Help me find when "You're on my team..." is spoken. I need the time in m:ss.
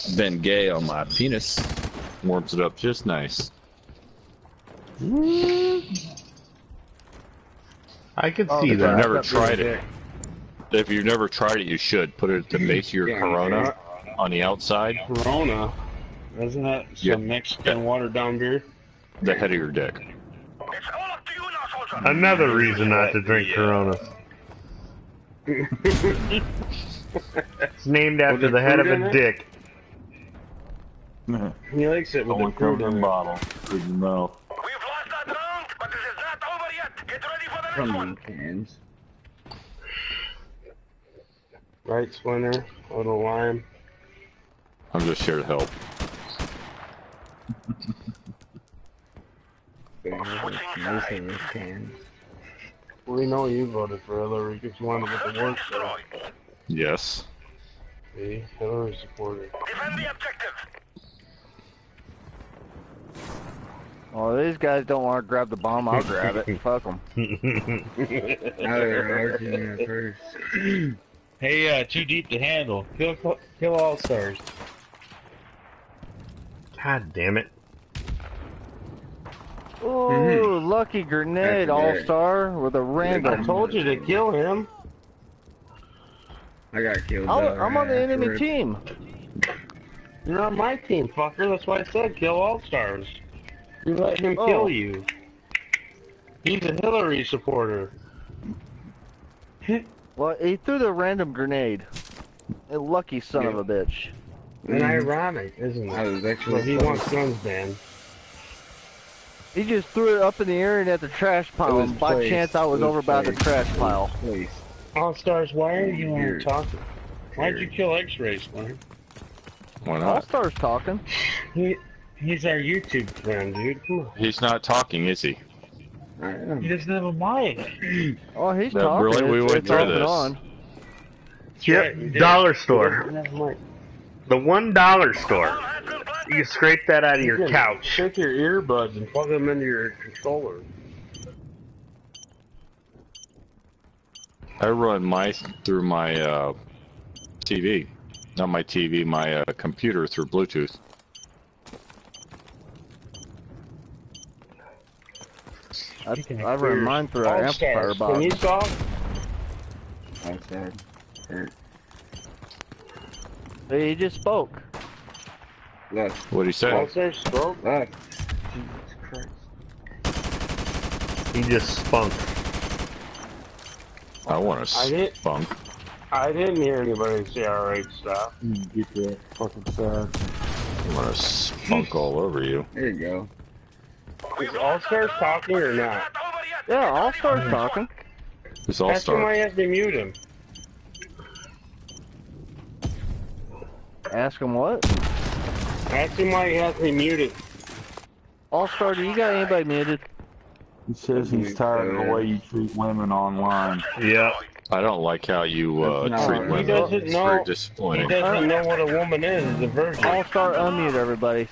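1:30.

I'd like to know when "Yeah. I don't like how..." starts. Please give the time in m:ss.
3:23.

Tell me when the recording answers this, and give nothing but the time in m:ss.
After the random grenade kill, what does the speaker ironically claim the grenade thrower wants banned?
1:47.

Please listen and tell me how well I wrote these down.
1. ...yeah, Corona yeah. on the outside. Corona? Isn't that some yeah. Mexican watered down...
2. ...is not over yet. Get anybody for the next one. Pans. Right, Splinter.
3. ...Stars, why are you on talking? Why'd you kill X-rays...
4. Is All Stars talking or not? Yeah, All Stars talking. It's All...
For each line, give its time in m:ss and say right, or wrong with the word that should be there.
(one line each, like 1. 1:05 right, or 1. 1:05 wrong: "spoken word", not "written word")
1. 0:13 right
2. 0:36 wrong: "ready", not "anybody"
3. 1:55 right
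4. 3:04 right.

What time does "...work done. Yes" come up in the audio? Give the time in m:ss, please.
0:55.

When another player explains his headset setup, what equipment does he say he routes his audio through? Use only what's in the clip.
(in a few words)
An amplifier box.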